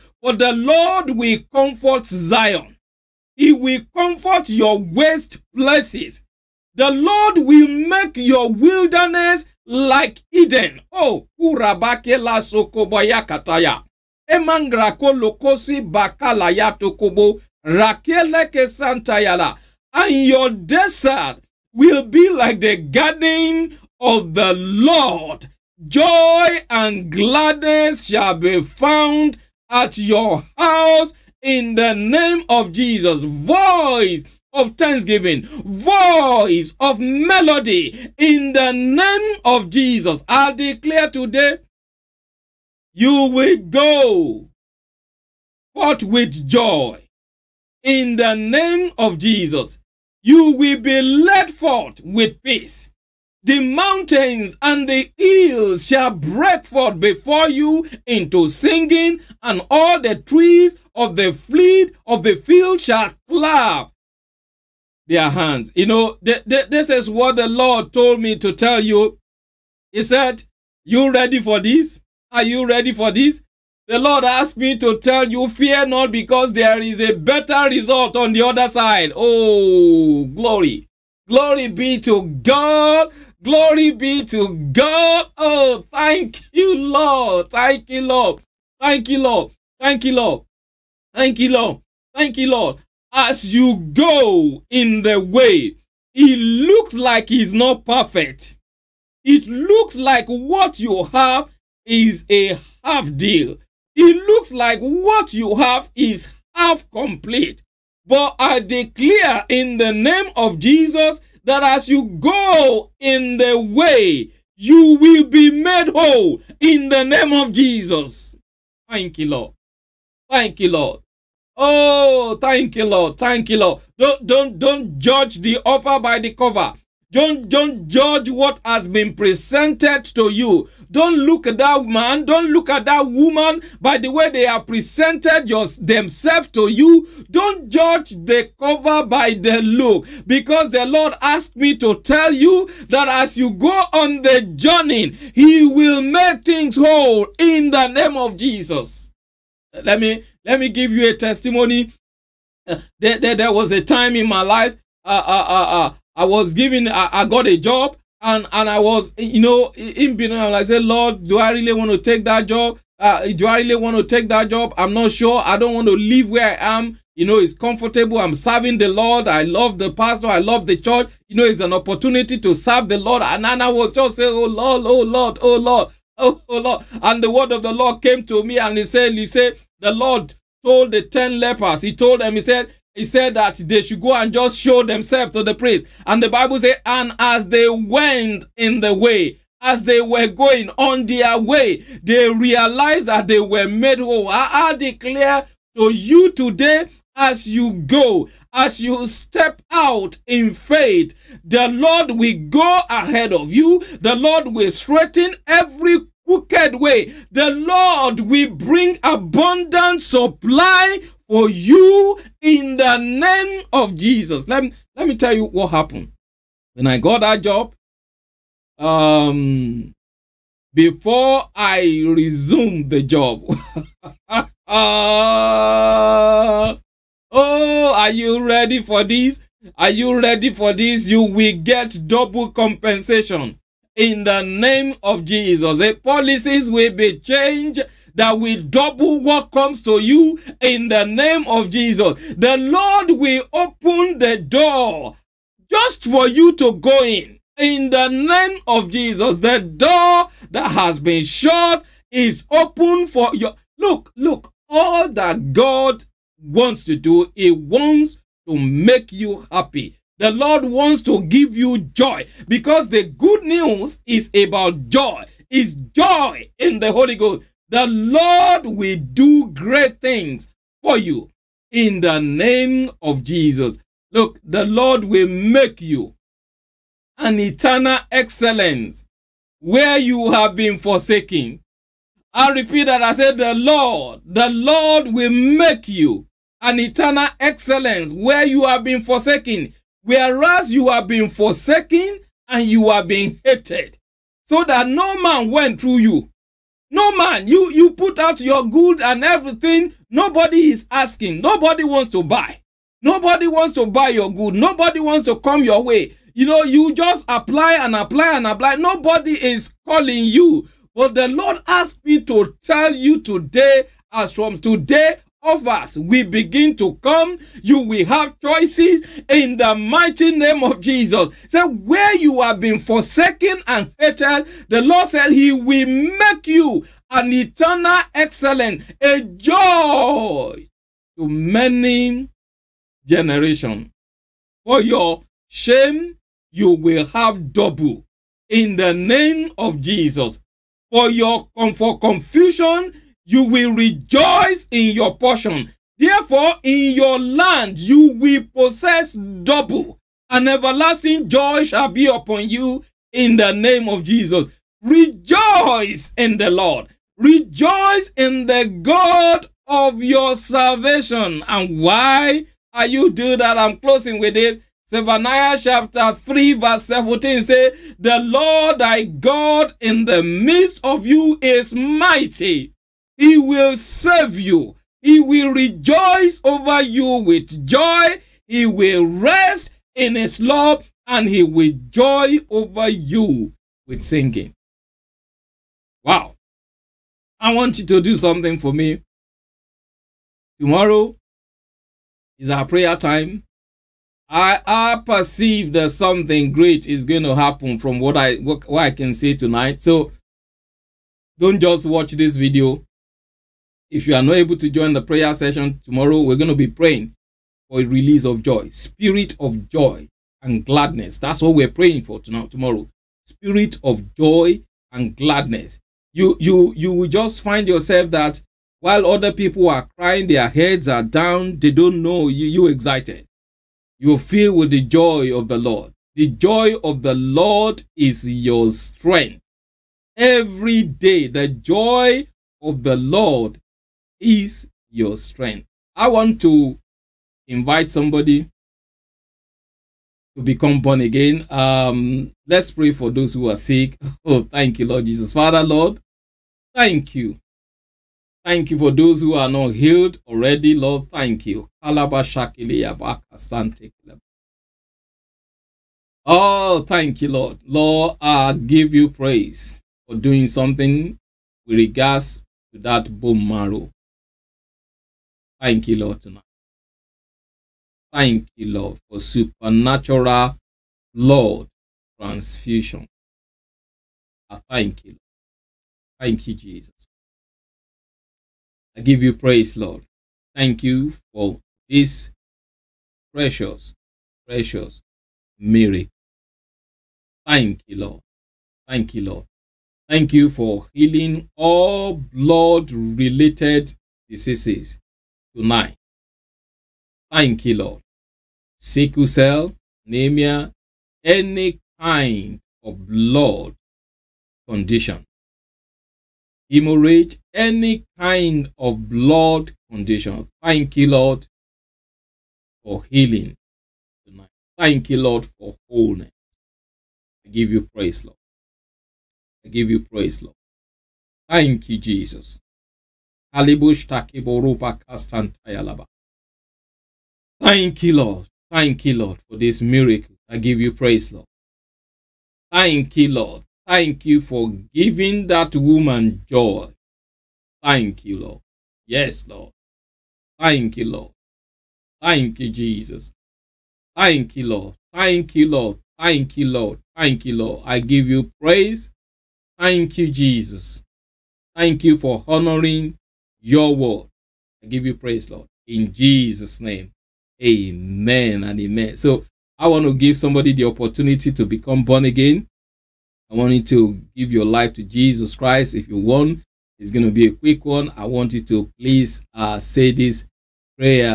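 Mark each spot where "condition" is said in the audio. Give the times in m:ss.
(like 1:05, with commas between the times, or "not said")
8:24, 8:29.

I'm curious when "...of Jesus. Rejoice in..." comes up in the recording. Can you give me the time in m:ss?
5:53.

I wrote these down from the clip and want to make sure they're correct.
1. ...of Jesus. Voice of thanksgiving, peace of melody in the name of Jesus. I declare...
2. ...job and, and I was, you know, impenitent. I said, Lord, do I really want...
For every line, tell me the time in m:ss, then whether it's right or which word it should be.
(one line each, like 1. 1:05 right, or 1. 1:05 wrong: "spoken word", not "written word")
1. 0:32 wrong: "voice", not "peace"
2. 2:37 right.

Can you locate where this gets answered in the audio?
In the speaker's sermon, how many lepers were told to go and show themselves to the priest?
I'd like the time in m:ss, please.
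3:01.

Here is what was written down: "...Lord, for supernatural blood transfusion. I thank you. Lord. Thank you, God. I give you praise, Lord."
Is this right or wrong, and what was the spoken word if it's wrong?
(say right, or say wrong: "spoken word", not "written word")
wrong: "Jesus", not "God".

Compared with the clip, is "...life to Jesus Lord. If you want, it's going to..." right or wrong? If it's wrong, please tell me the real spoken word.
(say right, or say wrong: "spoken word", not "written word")
wrong: "Christ", not "Lord".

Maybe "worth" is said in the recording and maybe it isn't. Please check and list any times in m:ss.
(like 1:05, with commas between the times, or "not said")
not said.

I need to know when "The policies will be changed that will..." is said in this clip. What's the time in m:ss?
3:55.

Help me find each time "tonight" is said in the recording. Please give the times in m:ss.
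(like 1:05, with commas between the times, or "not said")
6:39, 6:52, 7:46, 8:15, 8:34.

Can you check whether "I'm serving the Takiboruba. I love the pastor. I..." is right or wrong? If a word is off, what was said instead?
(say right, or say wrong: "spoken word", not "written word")
wrong: "Lord", not "Takiboruba".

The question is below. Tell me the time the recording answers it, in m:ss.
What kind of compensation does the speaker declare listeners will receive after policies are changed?
3:52.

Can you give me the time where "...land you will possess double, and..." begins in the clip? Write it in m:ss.
5:47.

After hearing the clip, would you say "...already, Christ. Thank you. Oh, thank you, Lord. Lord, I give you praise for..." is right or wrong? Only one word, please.
wrong.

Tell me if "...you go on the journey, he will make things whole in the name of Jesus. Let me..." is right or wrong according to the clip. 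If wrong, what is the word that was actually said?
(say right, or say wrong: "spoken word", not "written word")
right.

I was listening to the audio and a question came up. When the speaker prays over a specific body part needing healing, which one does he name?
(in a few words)
bone marrow.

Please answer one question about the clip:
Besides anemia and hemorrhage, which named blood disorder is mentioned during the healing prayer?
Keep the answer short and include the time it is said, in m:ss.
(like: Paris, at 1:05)
Sickle cell, at 8:18.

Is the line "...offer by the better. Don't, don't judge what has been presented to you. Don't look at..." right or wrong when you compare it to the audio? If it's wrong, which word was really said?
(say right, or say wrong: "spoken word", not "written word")
wrong: "cover", not "better".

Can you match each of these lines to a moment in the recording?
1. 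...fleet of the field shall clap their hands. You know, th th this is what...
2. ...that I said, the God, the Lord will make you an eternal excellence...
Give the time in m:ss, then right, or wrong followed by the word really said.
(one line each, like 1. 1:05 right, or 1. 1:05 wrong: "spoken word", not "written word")
1. 1:01 right
2. 4:42 wrong: "Lord", not "God".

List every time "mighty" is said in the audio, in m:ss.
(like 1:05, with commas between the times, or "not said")
5:19, 6:11.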